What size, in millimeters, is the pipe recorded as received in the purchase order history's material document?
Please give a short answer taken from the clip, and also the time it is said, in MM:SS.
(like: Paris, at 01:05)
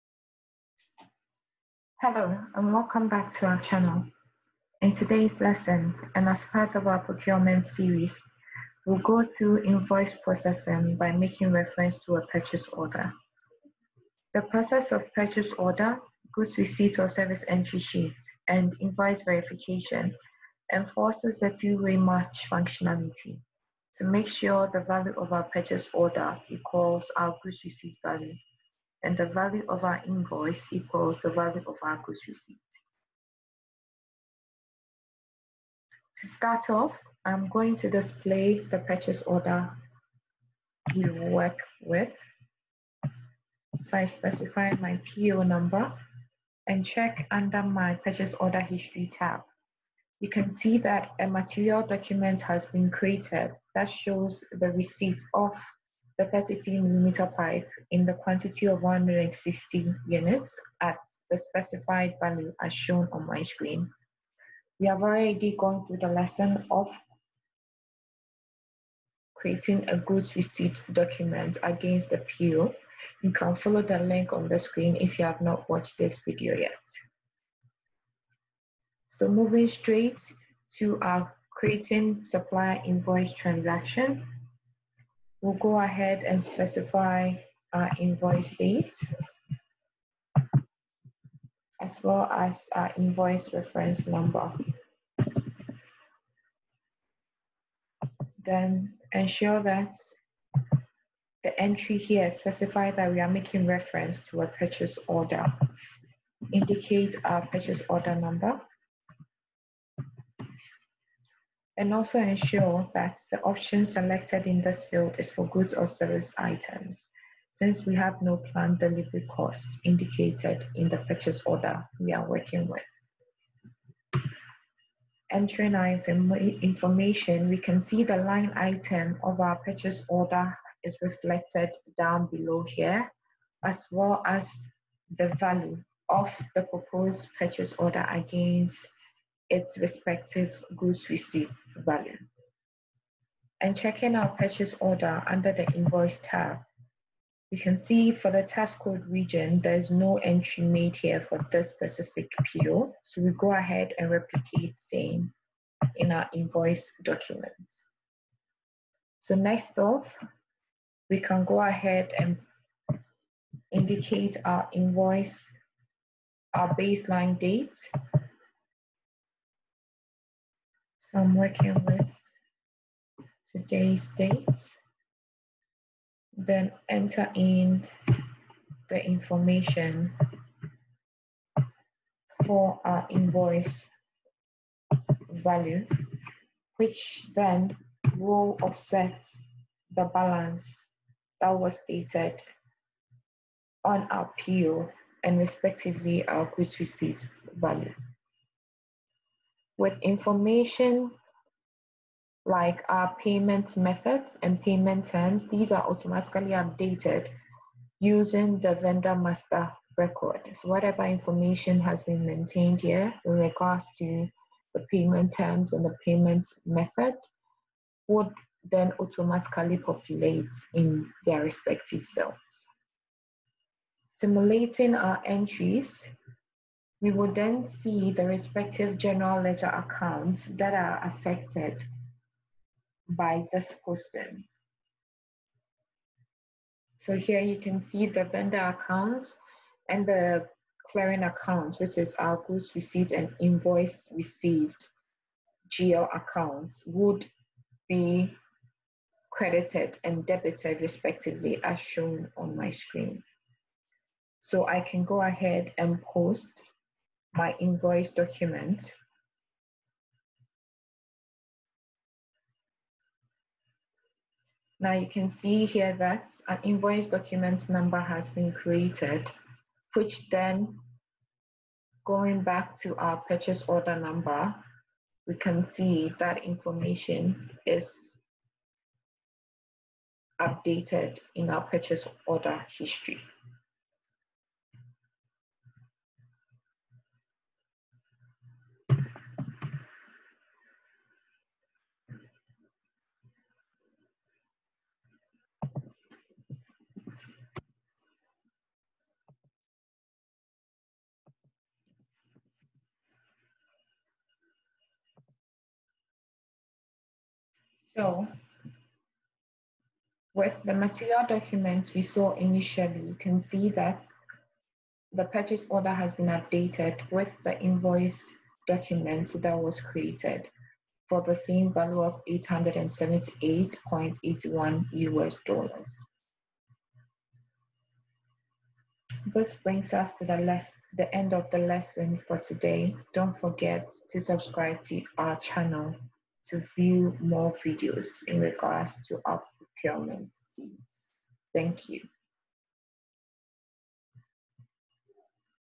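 33 millimeter, at 00:56.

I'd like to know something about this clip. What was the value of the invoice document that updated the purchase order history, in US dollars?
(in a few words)
$878.81.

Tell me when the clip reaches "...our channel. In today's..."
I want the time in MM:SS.
00:03.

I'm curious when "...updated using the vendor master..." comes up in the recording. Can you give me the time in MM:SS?
03:26.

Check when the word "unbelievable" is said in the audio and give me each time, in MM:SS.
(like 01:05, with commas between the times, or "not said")
not said.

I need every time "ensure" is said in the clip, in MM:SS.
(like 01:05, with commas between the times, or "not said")
01:39, 01:52.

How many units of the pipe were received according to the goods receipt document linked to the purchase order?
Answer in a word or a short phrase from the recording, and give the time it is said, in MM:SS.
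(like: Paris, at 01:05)
160, at 00:58.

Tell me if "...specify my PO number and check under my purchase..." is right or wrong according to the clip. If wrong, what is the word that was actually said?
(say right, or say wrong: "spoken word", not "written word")
right.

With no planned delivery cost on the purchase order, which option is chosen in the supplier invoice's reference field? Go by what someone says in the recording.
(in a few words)
goods or service items.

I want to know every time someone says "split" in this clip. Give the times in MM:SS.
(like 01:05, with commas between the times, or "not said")
not said.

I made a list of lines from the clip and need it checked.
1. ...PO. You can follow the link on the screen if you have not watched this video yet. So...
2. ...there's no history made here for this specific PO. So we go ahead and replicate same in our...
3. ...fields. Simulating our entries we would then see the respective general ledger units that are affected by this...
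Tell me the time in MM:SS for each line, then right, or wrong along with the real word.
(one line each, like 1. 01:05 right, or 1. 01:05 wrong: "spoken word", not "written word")
1. 01:12 right
2. 02:29 wrong: "entry", not "history"
3. 03:42 wrong: "accounts", not "units".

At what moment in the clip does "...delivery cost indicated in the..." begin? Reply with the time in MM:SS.
01:58.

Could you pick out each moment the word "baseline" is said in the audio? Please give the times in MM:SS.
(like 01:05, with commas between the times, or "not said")
02:46.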